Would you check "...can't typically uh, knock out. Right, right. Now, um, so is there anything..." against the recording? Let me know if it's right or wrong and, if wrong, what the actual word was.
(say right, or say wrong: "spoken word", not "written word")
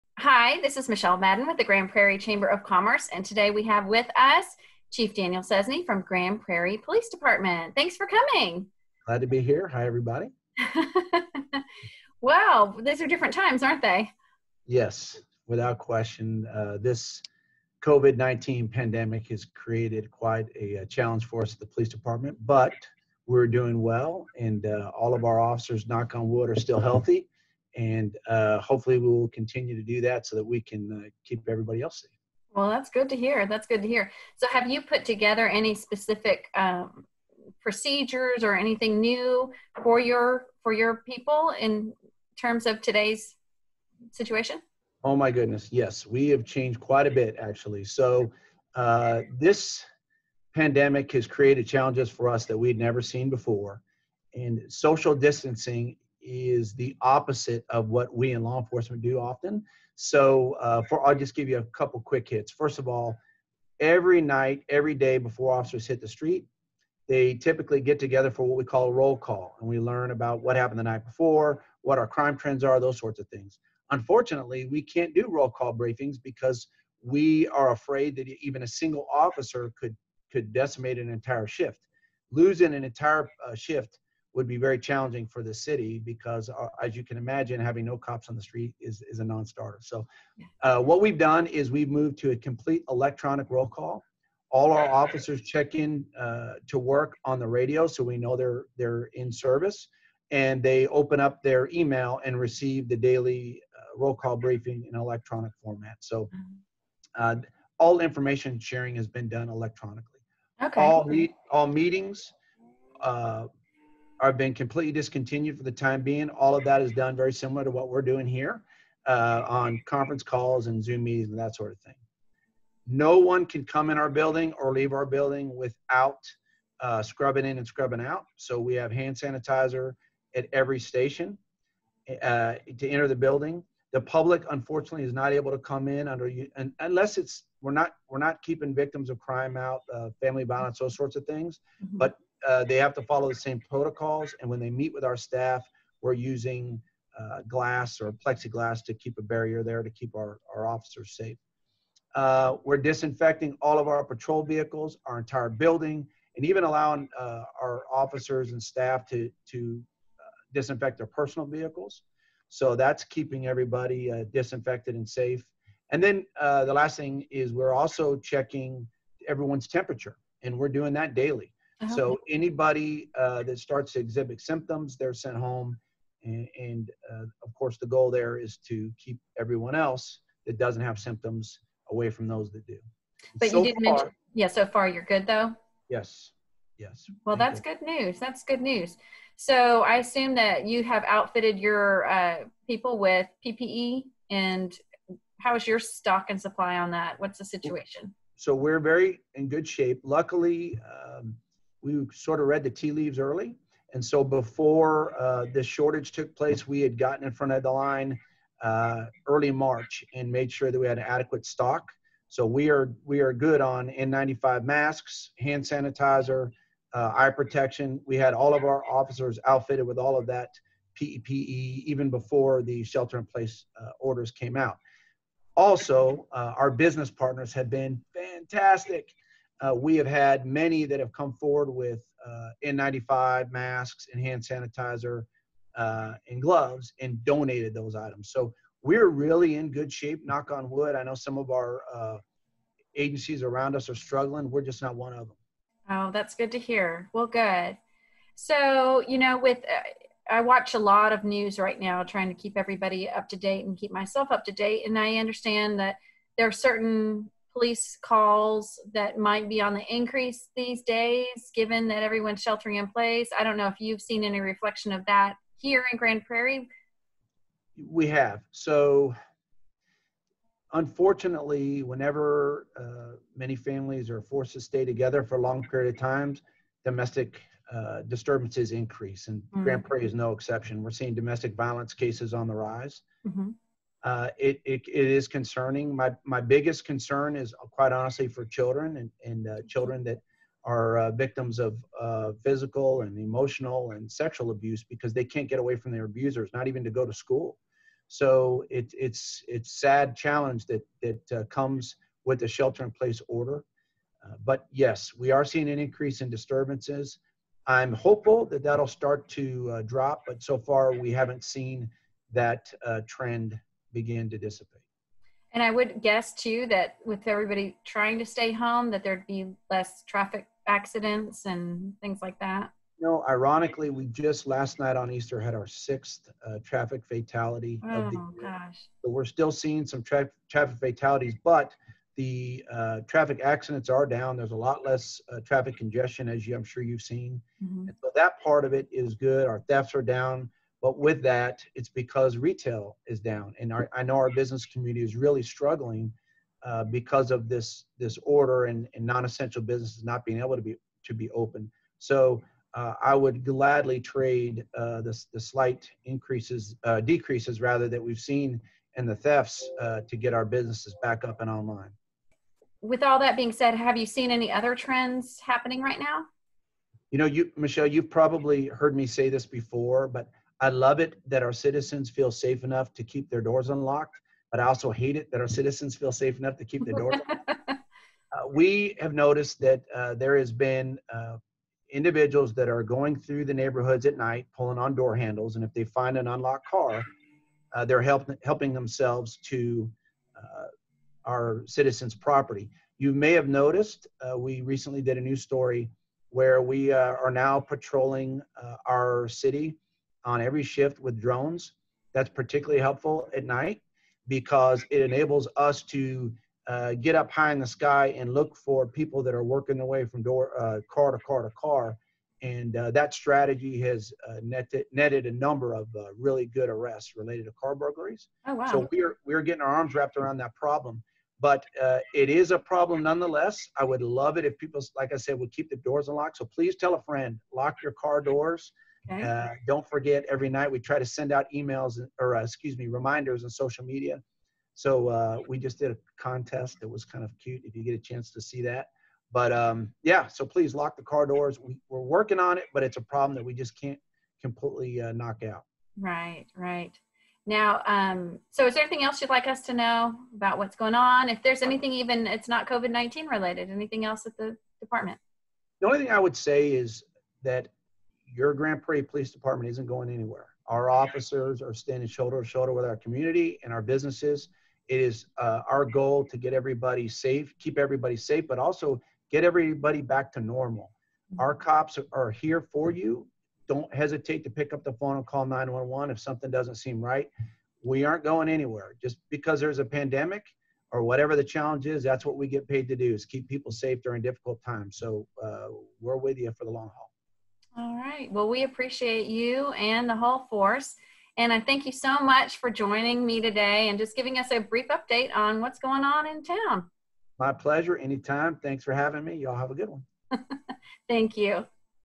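wrong: "completely", not "typically".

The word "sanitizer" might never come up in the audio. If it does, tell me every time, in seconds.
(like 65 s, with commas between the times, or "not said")
129 s, 215 s, 234 s.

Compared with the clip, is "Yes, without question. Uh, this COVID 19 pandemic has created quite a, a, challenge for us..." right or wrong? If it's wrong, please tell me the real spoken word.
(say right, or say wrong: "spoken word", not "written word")
right.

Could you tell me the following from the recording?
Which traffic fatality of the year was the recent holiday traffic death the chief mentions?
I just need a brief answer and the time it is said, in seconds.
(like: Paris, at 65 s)
6th, at 325 s.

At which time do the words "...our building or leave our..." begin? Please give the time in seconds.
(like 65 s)
123 s.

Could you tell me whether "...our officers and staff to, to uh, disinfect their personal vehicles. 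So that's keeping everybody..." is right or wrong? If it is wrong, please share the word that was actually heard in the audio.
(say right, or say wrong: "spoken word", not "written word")
right.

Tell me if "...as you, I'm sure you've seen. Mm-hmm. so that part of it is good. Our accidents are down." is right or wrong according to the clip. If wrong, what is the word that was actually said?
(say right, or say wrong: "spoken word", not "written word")
wrong: "thefts", not "accidents".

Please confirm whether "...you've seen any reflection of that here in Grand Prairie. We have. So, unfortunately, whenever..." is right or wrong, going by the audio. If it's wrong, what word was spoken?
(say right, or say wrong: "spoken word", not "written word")
right.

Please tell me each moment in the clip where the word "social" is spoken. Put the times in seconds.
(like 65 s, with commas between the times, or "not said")
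54 s, 433 s.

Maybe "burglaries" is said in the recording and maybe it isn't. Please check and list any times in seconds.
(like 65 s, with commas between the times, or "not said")
417 s.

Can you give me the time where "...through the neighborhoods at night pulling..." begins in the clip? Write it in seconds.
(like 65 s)
383 s.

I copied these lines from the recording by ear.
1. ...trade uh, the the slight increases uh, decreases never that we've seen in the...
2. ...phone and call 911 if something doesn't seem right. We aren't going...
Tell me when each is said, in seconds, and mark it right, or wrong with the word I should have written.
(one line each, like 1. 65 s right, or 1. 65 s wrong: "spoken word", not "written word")
1. 353 s wrong: "rather", not "never"
2. 474 s right.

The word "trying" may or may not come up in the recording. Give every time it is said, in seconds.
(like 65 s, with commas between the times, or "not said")
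252 s, 317 s.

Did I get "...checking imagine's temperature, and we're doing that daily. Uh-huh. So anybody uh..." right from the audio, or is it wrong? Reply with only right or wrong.
wrong.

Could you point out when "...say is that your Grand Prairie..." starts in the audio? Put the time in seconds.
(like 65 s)
456 s.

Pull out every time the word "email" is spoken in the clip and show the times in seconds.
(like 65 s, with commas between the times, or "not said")
101 s, 431 s.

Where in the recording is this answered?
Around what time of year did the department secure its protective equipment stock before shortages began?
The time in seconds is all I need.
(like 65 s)
209 s.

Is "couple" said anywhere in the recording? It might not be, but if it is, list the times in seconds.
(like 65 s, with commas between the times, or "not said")
61 s.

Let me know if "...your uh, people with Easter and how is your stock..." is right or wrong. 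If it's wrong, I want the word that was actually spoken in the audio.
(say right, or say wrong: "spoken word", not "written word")
wrong: "PPE", not "Easter".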